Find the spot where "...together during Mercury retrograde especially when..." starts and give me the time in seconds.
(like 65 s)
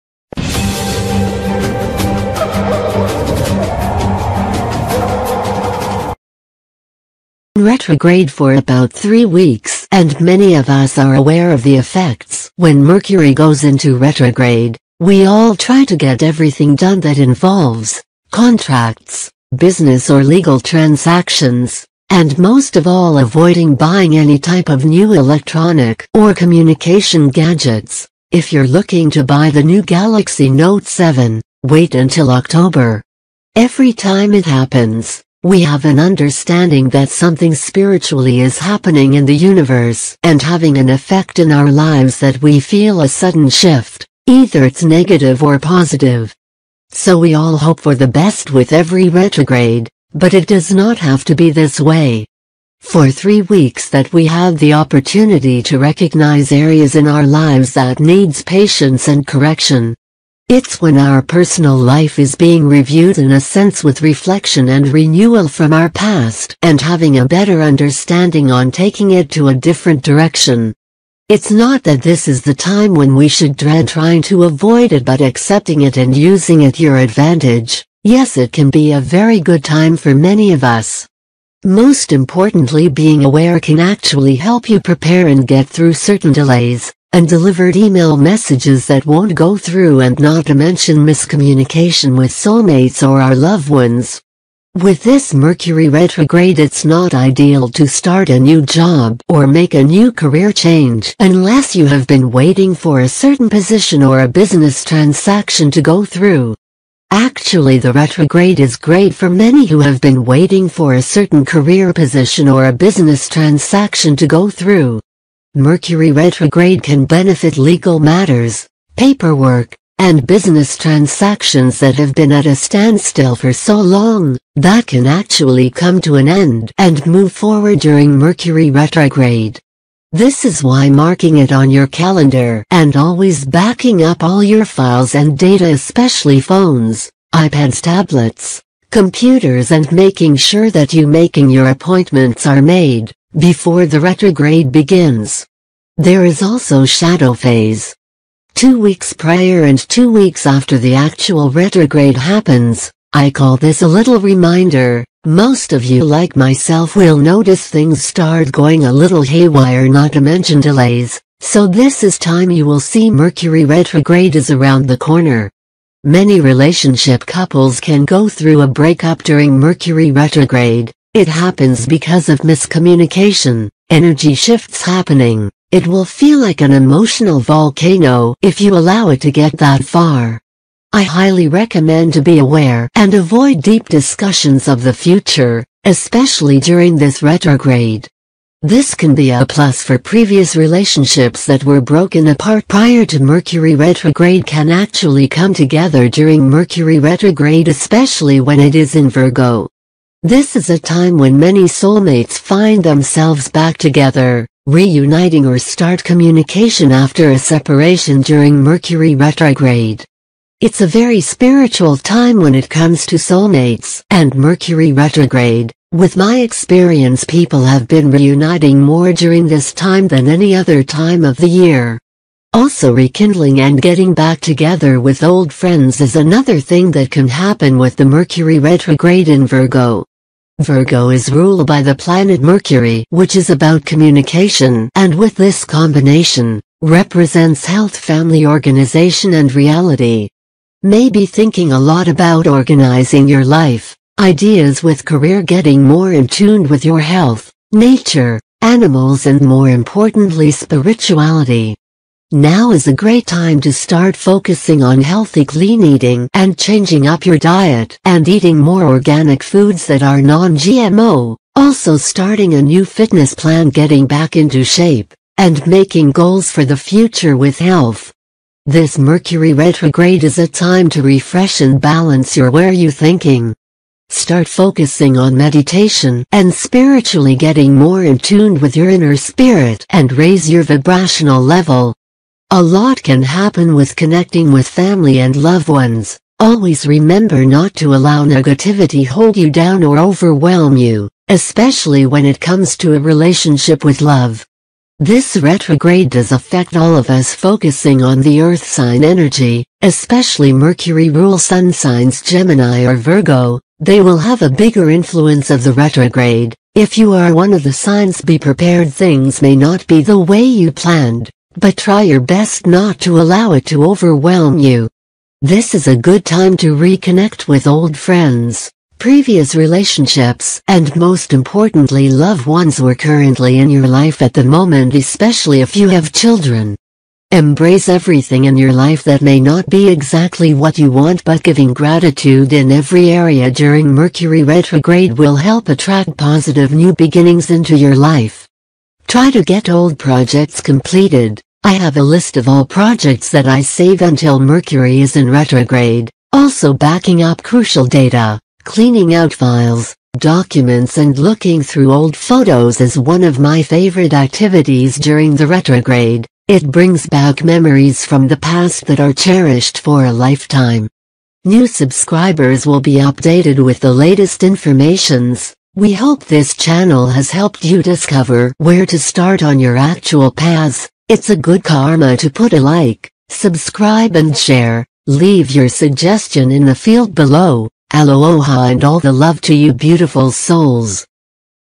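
195 s.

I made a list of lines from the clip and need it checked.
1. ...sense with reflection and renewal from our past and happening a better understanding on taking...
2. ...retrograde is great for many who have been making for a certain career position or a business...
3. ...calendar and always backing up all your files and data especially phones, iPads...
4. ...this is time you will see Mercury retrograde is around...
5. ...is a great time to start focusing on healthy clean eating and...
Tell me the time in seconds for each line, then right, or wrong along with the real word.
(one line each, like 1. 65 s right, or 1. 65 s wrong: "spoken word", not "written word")
1. 63 s wrong: "having", not "happening"
2. 107 s wrong: "waiting", not "making"
3. 131 s right
4. 161 s right
5. 252 s right.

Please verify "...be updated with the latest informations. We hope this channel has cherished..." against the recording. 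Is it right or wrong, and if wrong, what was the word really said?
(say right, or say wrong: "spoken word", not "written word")
wrong: "helped", not "cherished".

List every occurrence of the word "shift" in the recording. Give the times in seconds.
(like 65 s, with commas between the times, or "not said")
43 s, 174 s.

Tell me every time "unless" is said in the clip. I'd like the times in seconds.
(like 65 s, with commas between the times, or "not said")
101 s.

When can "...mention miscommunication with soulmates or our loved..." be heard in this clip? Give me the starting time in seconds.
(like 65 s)
90 s.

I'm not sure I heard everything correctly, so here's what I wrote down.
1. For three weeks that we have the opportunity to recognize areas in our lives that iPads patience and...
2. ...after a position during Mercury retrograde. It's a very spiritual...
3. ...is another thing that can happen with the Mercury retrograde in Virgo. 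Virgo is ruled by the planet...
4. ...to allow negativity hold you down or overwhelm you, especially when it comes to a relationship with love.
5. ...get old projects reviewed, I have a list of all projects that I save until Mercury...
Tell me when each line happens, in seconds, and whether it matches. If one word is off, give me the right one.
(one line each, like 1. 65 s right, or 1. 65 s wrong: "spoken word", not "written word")
1. 52 s wrong: "needs", not "iPads"
2. 206 s wrong: "separation", not "position"
3. 225 s right
4. 287 s right
5. 339 s wrong: "completed", not "reviewed".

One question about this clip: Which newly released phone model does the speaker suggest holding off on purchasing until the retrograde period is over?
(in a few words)
Galaxy Note 7.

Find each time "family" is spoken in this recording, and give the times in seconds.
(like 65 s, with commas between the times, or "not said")
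237 s, 284 s.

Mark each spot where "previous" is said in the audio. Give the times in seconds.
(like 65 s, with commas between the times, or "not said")
189 s, 318 s.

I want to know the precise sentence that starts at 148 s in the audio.
Two weeks prior and two weeks after the actual retrograde happens, I call this a little reminder.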